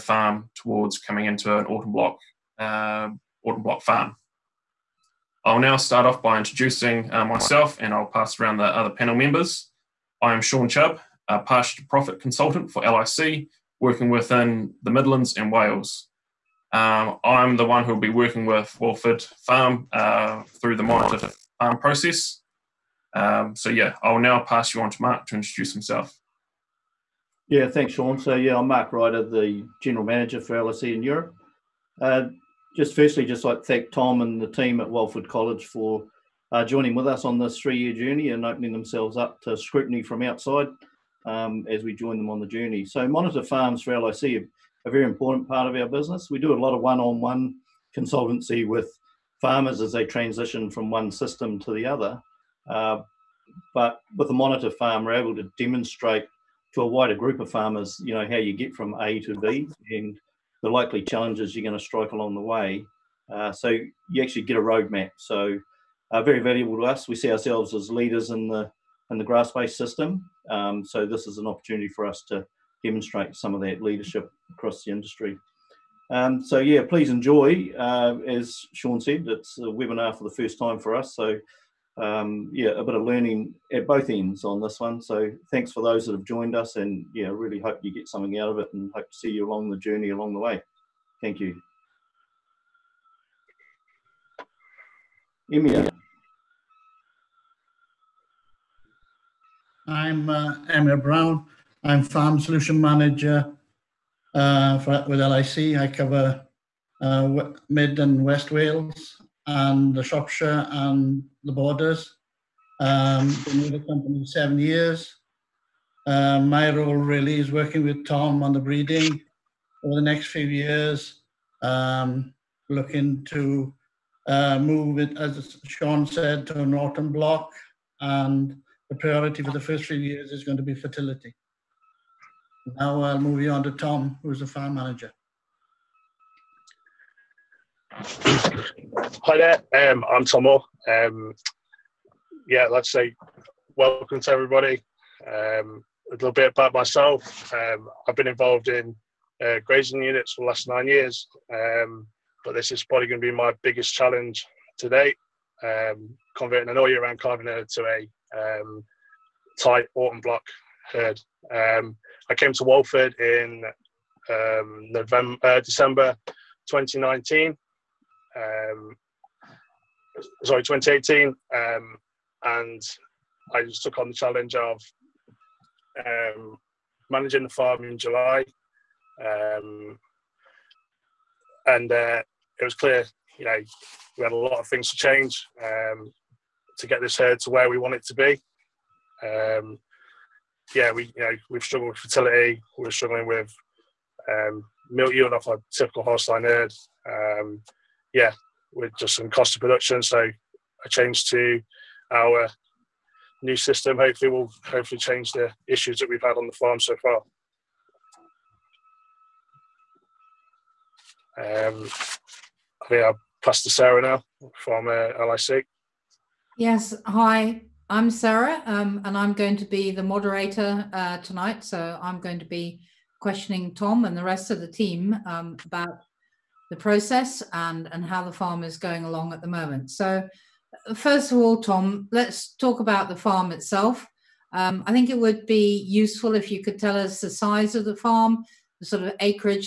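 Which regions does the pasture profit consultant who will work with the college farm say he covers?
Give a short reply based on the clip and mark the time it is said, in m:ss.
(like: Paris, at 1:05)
Midlands and Wales, at 0:14.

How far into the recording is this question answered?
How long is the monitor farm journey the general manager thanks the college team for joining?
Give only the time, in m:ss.
0:37.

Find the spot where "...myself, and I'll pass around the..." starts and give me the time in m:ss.
0:07.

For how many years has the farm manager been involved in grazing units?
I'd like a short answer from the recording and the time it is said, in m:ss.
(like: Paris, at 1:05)
9 years, at 2:30.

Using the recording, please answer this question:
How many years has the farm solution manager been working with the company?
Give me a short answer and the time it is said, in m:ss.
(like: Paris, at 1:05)
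7 years, at 1:54.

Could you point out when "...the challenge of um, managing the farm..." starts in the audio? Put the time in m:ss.
2:54.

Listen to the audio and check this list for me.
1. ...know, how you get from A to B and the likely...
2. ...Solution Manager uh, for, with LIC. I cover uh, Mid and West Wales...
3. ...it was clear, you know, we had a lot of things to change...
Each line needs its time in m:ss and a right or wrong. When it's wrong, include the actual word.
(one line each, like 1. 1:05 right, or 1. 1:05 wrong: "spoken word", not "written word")
1. 0:58 right
2. 1:42 right
3. 3:02 right.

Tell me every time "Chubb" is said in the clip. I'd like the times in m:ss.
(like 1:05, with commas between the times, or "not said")
0:10.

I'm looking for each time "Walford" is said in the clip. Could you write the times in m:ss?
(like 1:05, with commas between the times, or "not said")
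0:18, 0:34, 2:42.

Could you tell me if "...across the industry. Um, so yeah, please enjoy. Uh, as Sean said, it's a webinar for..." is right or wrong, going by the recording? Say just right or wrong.
right.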